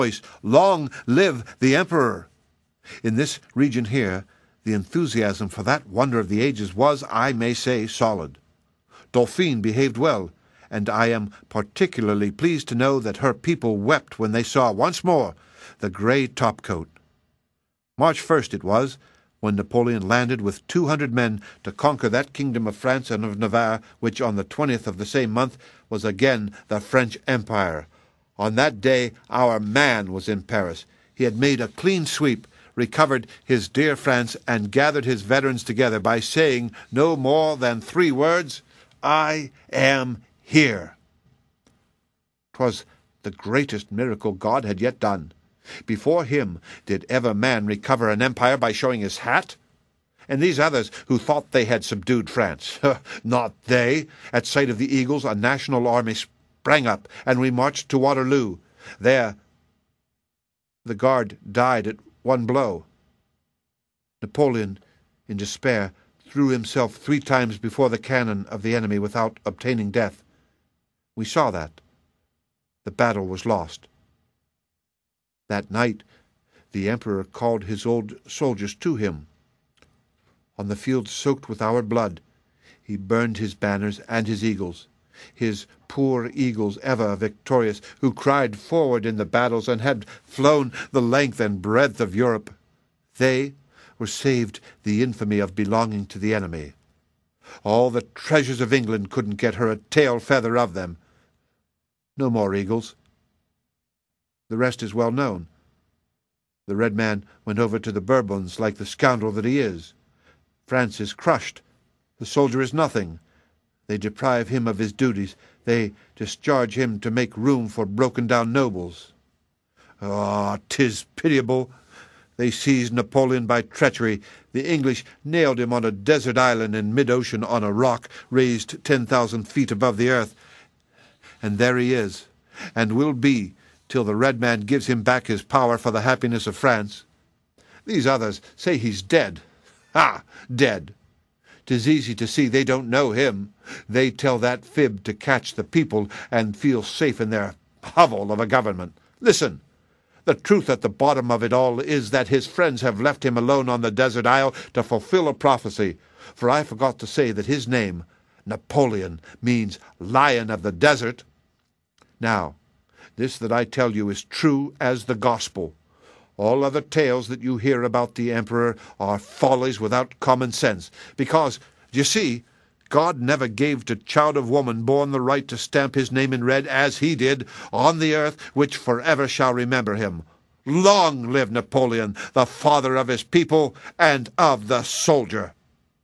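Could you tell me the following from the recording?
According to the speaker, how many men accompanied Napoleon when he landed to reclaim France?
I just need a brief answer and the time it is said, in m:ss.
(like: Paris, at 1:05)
200, at 0:20.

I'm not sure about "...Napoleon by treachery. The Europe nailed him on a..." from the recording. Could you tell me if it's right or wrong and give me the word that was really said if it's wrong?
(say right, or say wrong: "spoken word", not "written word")
wrong: "English", not "Europe".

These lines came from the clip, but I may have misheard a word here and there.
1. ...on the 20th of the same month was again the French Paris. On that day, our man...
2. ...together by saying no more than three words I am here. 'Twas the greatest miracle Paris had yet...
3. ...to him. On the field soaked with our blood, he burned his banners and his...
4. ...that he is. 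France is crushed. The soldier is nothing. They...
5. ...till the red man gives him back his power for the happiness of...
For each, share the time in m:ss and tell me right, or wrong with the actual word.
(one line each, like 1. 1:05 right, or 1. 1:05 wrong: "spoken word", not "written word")
1. 0:24 wrong: "Empire", not "Paris"
2. 0:35 wrong: "God", not "Paris"
3. 1:18 right
4. 1:49 right
5. 2:13 right.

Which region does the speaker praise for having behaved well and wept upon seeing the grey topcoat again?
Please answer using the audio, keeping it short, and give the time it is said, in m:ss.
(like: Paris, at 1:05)
Dauphine, at 0:09.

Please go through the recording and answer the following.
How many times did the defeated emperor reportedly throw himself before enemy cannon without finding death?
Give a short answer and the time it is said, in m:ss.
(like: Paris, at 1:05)
3, at 1:06.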